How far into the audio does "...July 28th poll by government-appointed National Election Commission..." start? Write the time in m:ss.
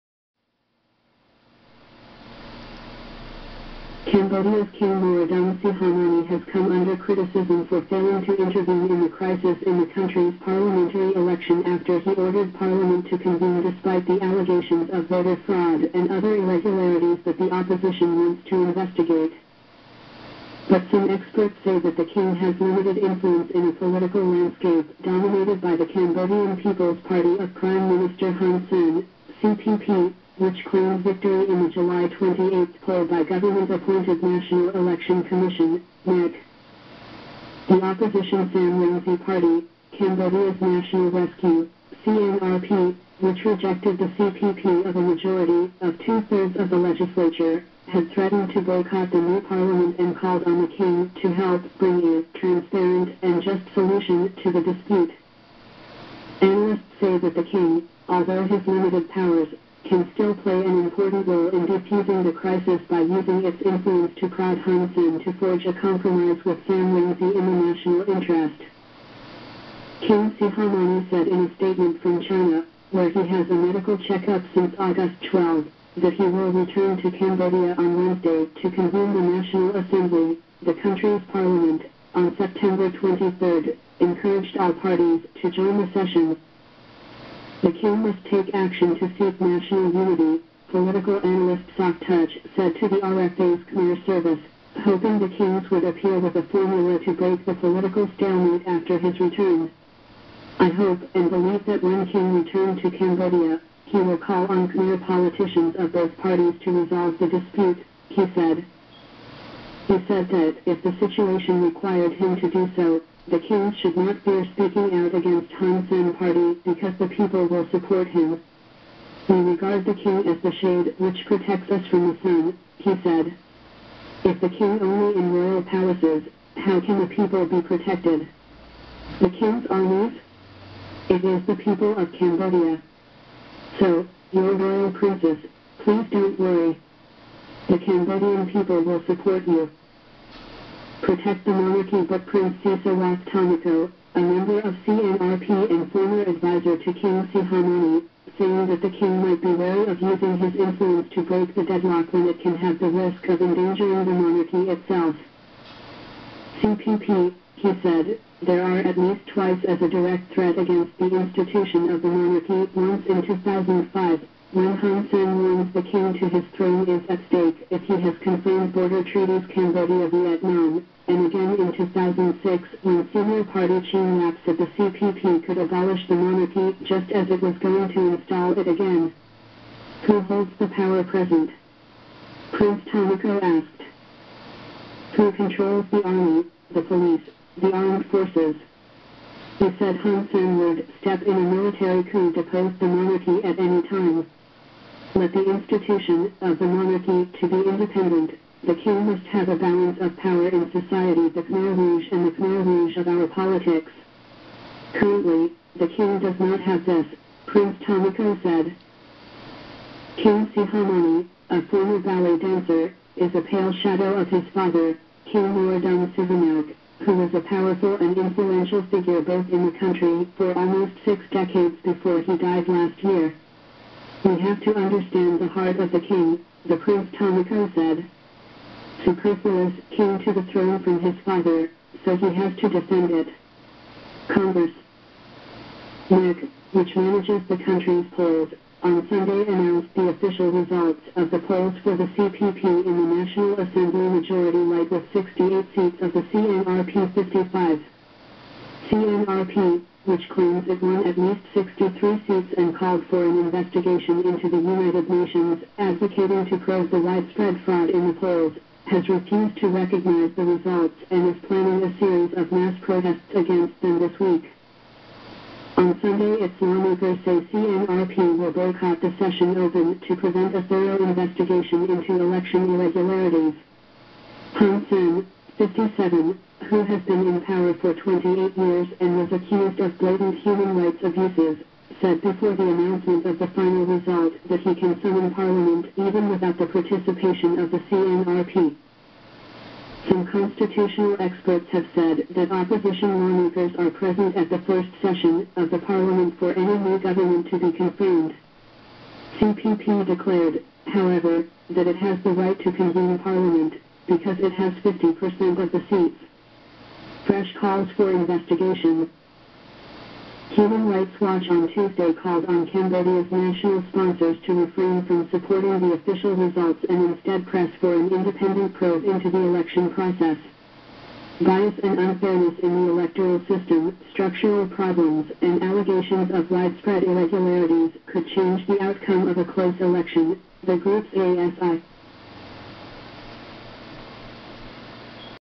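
0:31.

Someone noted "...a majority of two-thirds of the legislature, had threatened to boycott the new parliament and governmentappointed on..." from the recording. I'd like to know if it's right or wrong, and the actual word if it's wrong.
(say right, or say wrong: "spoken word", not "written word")
wrong: "called", not "governmentappointed".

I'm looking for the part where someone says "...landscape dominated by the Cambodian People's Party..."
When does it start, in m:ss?
0:24.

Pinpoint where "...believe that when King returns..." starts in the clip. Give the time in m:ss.
1:41.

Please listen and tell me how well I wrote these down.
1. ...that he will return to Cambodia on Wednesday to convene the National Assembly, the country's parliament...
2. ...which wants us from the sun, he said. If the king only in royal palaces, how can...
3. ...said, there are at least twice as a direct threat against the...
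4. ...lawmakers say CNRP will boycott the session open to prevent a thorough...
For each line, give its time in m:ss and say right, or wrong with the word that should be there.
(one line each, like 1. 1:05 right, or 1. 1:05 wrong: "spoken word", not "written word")
1. 1:15 right
2. 2:00 wrong: "protects", not "wants"
3. 2:37 right
4. 4:26 right.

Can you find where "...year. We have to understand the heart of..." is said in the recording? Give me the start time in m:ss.
3:43.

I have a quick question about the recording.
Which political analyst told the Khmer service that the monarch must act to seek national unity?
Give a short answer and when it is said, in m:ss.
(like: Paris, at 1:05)
Sok Touch, at 1:31.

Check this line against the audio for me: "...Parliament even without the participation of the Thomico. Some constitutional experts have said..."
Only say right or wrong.
wrong.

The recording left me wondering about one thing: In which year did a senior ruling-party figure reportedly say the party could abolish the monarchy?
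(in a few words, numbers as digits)
2006.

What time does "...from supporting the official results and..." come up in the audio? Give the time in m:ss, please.
5:15.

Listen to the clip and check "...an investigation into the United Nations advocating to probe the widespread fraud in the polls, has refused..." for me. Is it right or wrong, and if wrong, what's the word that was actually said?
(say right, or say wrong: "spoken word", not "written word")
right.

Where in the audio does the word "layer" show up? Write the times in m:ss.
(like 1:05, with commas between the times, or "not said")
not said.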